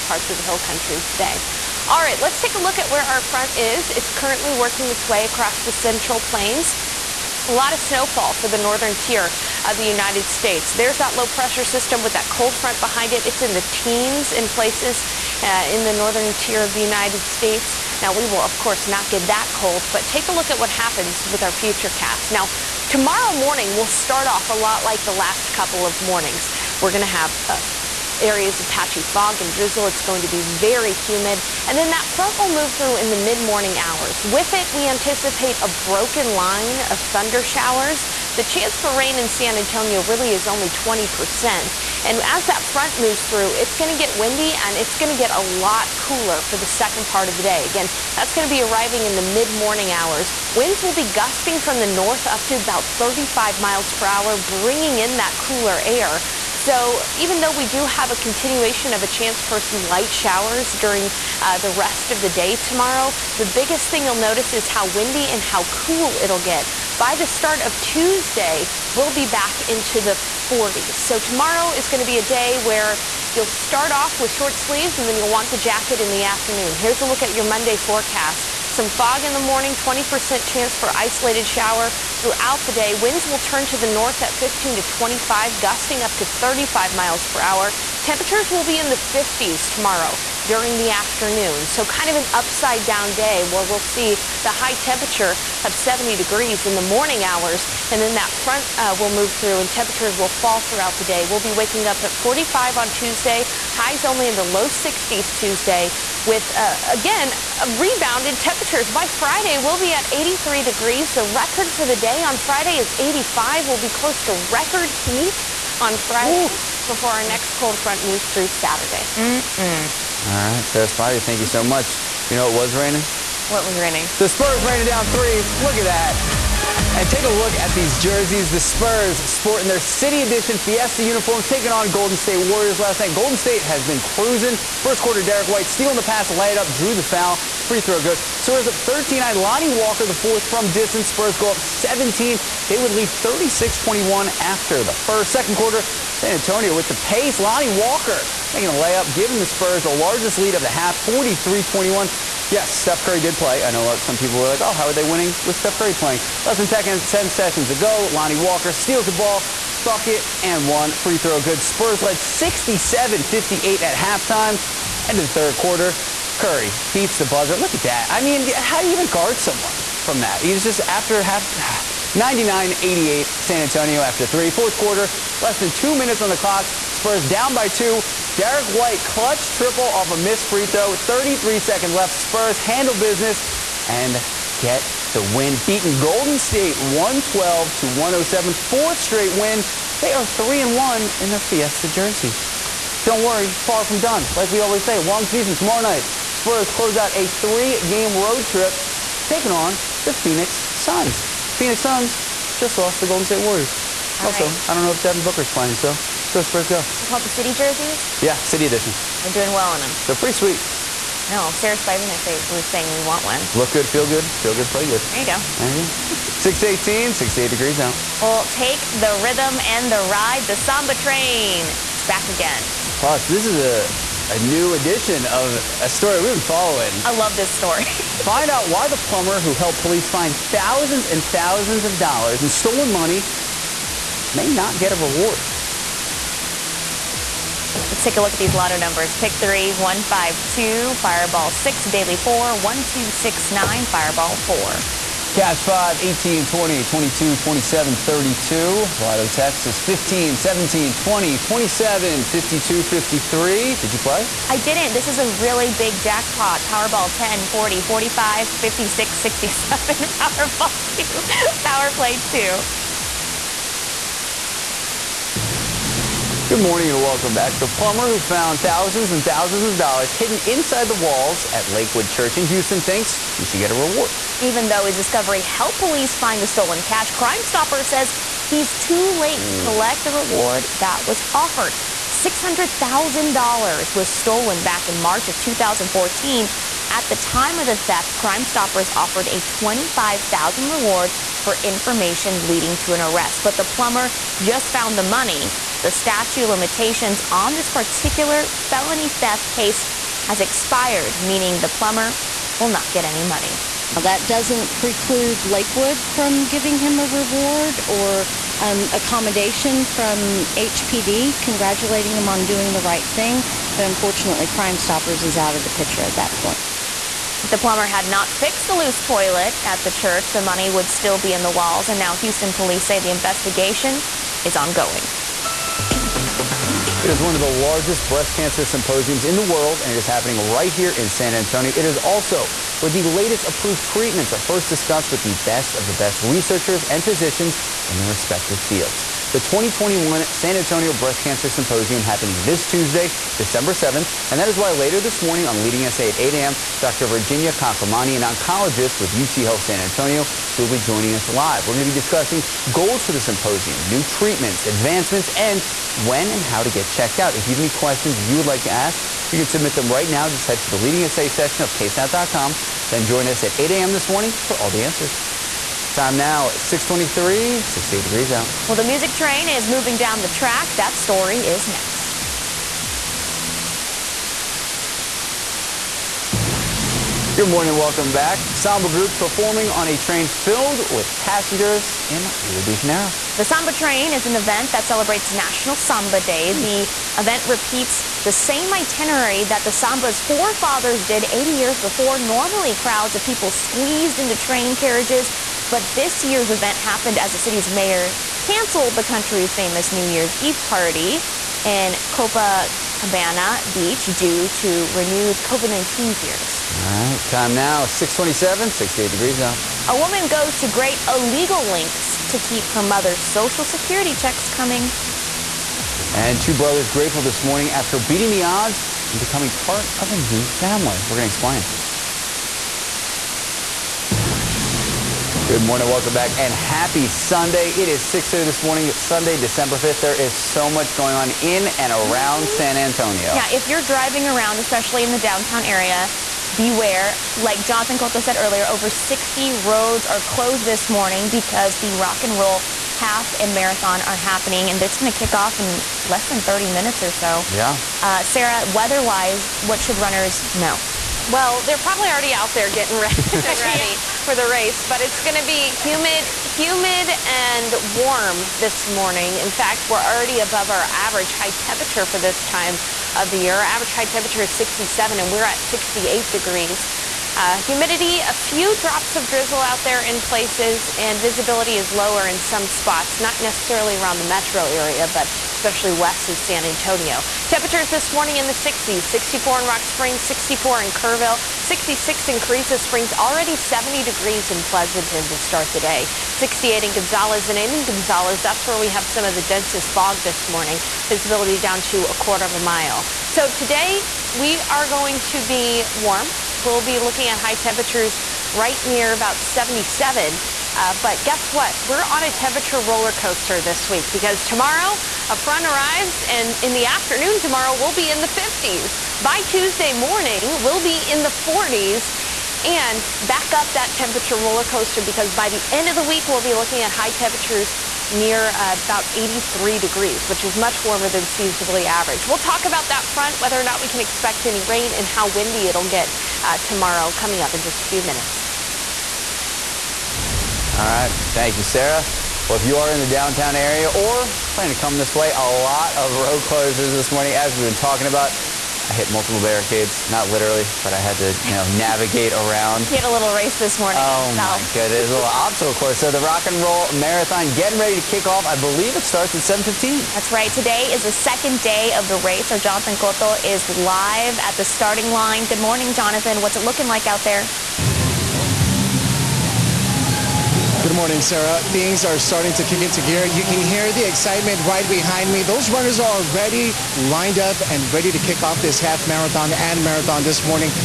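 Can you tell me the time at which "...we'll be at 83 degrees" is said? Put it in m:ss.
1:49.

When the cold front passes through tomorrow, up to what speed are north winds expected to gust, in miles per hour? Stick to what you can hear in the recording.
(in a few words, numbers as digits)
35.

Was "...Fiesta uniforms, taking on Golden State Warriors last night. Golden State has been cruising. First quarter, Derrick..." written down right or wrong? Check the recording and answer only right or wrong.
right.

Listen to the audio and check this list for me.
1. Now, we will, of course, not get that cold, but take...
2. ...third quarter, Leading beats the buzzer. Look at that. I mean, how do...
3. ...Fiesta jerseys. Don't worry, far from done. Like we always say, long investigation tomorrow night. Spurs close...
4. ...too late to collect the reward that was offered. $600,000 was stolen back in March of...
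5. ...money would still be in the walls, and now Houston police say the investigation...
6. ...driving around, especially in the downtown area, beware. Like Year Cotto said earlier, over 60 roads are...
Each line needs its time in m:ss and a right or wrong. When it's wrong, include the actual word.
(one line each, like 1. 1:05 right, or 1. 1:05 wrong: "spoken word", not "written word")
1. 0:18 right
2. 2:45 wrong: "Curry", not "Leading"
3. 3:11 wrong: "season", not "investigation"
4. 4:38 right
5. 5:20 right
6. 7:13 wrong: "Jonathan", not "Year".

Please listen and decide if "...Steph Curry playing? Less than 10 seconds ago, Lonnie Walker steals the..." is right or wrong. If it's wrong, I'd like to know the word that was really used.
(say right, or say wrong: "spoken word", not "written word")
right.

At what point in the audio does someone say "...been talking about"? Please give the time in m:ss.
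8:57.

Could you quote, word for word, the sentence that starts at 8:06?
68 in Gonzales and in Gonzales, that's where we have some of the densest fog this morning.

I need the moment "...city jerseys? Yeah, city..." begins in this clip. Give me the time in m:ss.
3:27.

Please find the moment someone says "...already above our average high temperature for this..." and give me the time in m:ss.
7:40.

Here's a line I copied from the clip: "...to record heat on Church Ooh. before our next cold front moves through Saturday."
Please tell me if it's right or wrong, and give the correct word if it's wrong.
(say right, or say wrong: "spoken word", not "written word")
wrong: "Friday", not "Church".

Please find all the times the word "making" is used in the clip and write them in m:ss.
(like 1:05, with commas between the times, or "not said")
2:28.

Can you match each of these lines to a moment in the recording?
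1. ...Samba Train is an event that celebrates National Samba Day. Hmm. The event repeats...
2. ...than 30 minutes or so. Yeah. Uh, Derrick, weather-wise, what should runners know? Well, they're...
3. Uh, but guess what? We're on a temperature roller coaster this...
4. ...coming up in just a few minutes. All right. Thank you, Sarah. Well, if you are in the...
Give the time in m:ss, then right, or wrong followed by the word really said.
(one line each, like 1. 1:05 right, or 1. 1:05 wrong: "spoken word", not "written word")
1. 6:23 right
2. 7:26 wrong: "Sarah", not "Derrick"
3. 8:20 right
4. 8:47 right.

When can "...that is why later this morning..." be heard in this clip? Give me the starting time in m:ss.
5:44.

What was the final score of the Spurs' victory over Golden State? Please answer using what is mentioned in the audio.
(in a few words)
112 to 107.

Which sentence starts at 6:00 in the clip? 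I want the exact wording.
Just head to the Leading SA section of ksat.com.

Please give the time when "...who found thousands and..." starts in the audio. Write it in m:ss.
4:28.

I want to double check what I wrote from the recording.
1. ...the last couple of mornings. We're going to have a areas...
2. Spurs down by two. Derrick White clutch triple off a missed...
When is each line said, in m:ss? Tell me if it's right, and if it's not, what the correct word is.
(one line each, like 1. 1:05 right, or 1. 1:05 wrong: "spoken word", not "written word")
1. 0:25 right
2. 2:56 right.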